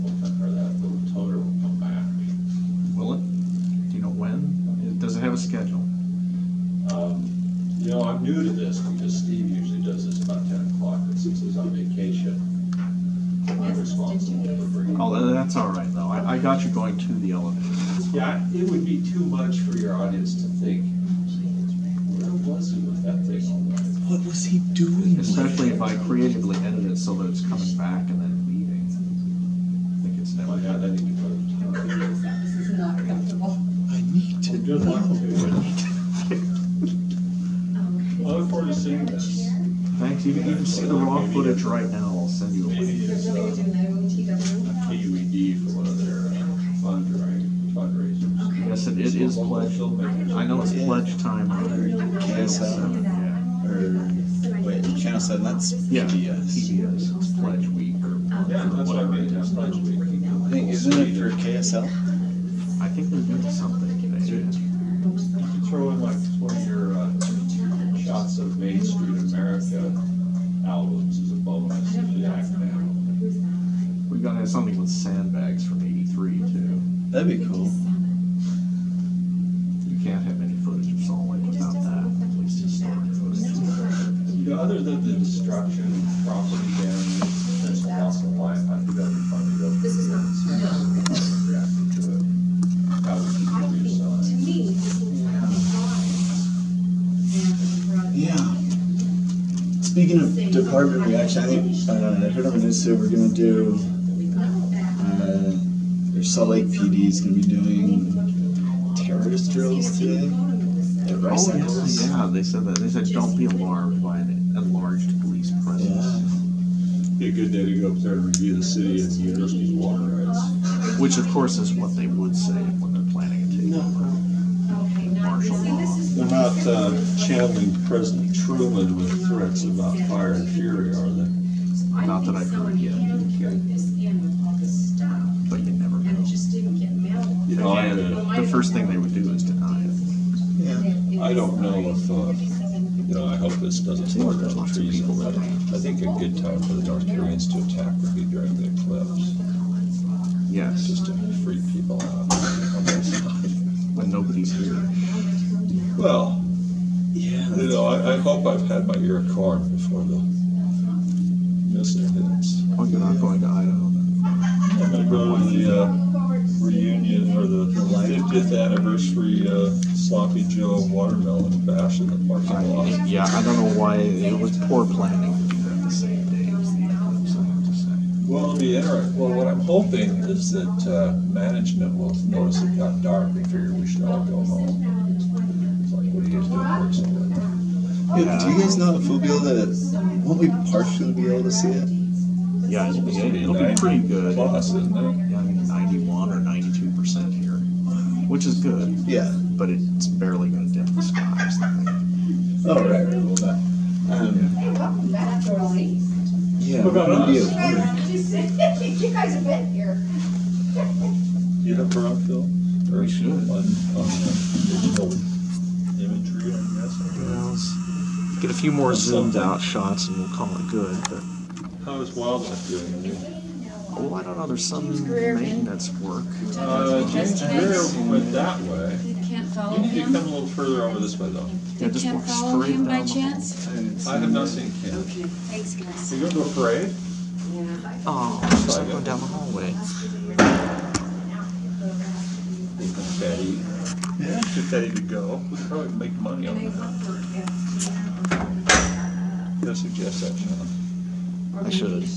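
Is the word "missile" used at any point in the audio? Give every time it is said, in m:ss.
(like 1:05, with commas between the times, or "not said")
2:41.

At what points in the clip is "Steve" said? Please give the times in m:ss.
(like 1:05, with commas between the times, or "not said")
0:09.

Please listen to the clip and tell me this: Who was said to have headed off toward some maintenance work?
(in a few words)
James Greer.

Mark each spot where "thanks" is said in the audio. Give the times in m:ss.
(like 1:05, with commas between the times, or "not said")
0:39, 3:55.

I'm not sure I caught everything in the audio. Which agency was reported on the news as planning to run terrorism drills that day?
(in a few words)
Salt Lake PD.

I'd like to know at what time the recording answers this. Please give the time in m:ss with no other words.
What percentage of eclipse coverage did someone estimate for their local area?
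3:15.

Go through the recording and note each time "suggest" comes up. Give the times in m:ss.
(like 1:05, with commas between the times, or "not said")
4:09.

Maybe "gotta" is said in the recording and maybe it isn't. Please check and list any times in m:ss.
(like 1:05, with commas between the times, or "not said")
1:14, 4:09.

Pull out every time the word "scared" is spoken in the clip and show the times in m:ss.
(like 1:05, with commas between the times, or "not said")
not said.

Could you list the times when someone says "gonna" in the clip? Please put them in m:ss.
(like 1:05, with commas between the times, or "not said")
1:43, 1:47.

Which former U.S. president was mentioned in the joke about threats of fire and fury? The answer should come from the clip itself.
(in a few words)
Truman.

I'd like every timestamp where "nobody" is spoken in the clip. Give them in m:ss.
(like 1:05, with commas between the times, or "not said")
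2:34.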